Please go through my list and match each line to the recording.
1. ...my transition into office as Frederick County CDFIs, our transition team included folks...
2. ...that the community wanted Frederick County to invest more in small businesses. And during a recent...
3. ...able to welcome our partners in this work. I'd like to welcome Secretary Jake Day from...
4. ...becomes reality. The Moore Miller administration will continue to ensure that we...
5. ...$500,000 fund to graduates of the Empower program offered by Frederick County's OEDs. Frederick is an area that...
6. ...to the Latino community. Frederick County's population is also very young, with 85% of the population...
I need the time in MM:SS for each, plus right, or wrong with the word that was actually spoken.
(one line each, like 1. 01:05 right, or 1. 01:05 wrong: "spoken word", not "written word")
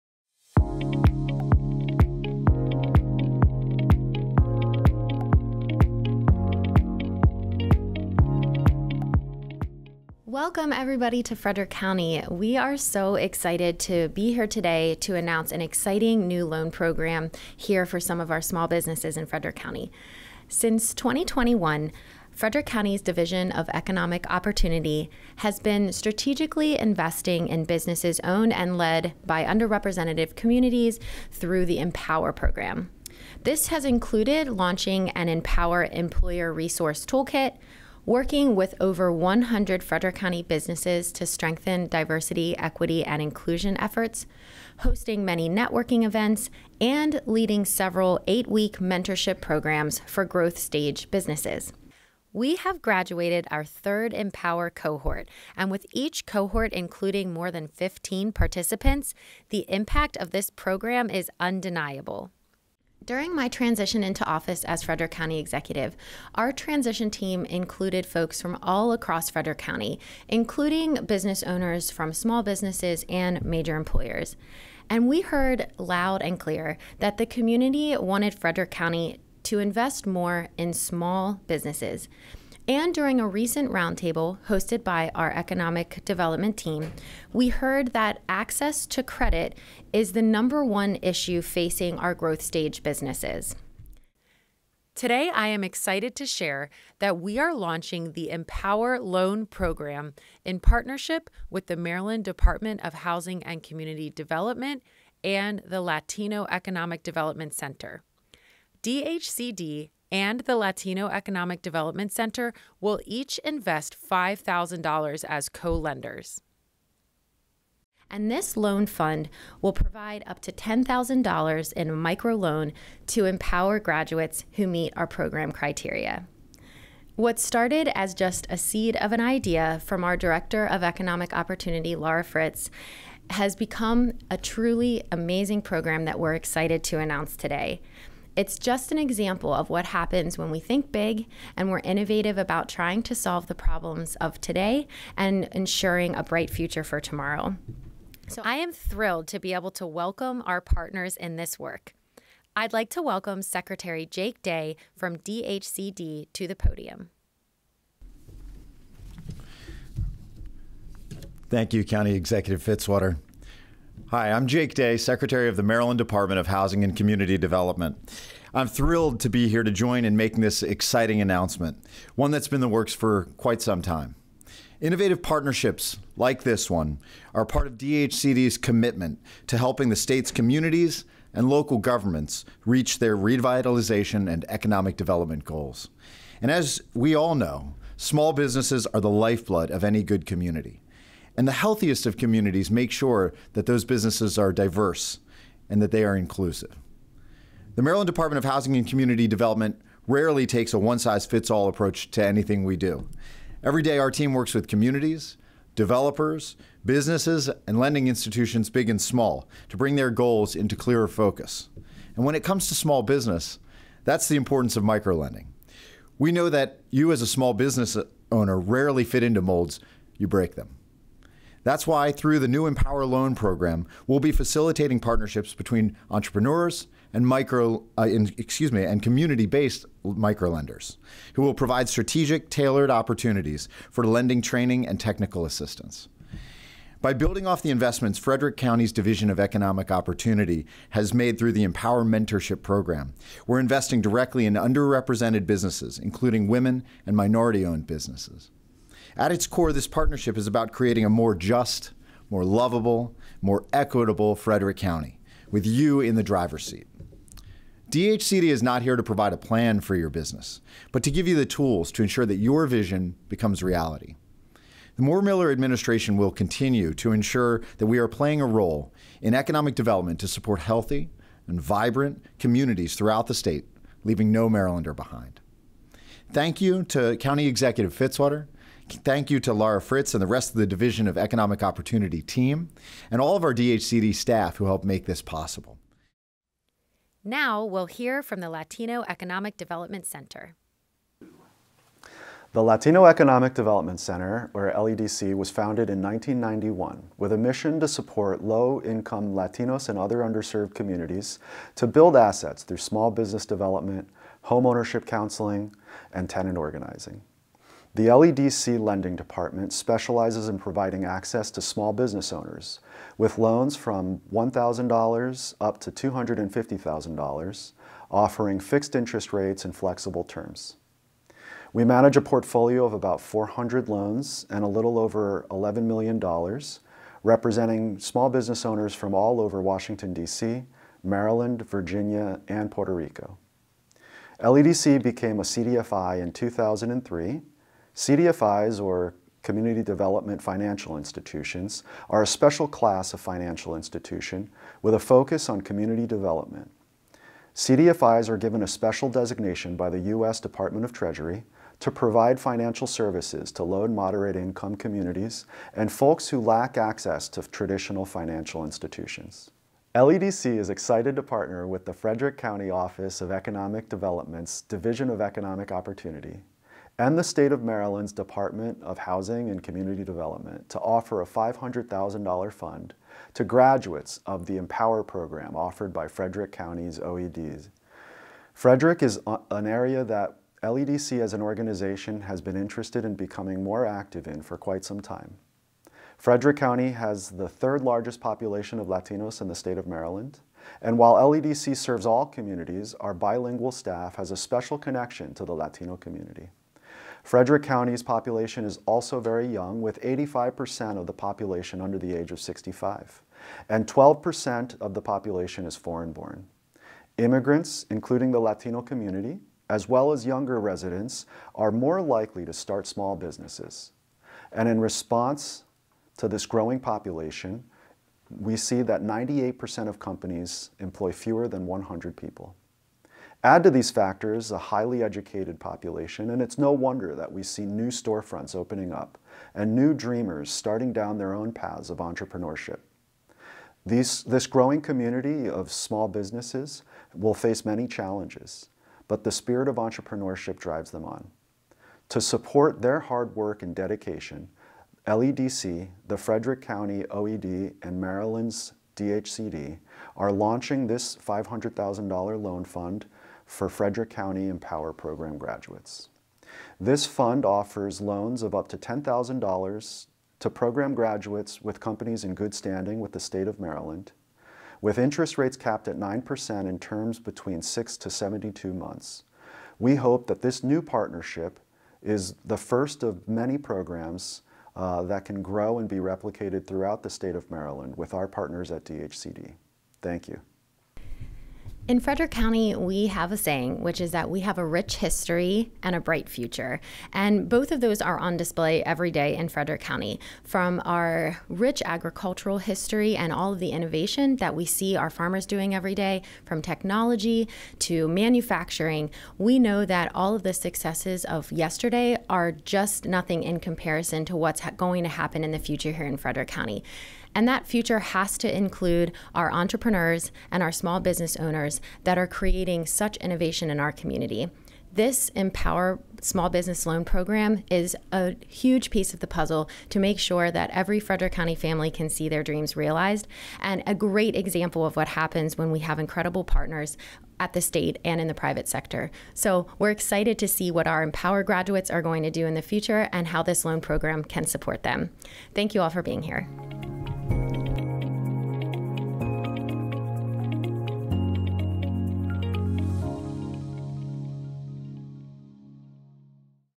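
1. 01:03 wrong: "Executive", not "CDFIs"
2. 01:16 right
3. 02:29 right
4. 04:23 right
5. 06:11 right
6. 06:35 right.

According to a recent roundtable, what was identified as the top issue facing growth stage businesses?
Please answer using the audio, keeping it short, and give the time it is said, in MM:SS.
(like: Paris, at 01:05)
Access to credit, at 01:28.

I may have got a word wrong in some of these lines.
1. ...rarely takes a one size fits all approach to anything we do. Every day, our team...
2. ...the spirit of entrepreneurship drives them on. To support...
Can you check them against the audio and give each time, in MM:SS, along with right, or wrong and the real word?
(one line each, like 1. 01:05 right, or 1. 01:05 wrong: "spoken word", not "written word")
1. 03:20 right
2. 07:19 right.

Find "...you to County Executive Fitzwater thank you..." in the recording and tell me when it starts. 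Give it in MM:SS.
04:36.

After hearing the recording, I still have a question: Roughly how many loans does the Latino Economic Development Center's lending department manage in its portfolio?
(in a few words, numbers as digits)
400.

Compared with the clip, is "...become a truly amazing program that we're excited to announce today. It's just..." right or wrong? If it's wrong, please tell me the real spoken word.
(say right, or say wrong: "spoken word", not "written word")
right.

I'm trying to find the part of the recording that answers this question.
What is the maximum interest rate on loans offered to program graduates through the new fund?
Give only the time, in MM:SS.
07:45.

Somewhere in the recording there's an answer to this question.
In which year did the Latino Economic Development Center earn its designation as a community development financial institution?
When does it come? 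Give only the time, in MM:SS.
05:36.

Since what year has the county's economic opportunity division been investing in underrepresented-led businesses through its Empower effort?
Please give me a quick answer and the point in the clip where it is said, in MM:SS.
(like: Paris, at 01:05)
2021, at 00:20.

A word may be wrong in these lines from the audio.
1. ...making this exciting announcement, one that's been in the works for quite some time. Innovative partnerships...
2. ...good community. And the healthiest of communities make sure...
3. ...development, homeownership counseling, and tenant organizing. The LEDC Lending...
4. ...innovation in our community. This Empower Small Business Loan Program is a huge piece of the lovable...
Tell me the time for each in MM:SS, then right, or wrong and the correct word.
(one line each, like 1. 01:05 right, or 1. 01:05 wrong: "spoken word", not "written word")
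1. 02:50 right
2. 03:10 right
3. 05:03 right
4. 08:33 wrong: "puzzle", not "lovable".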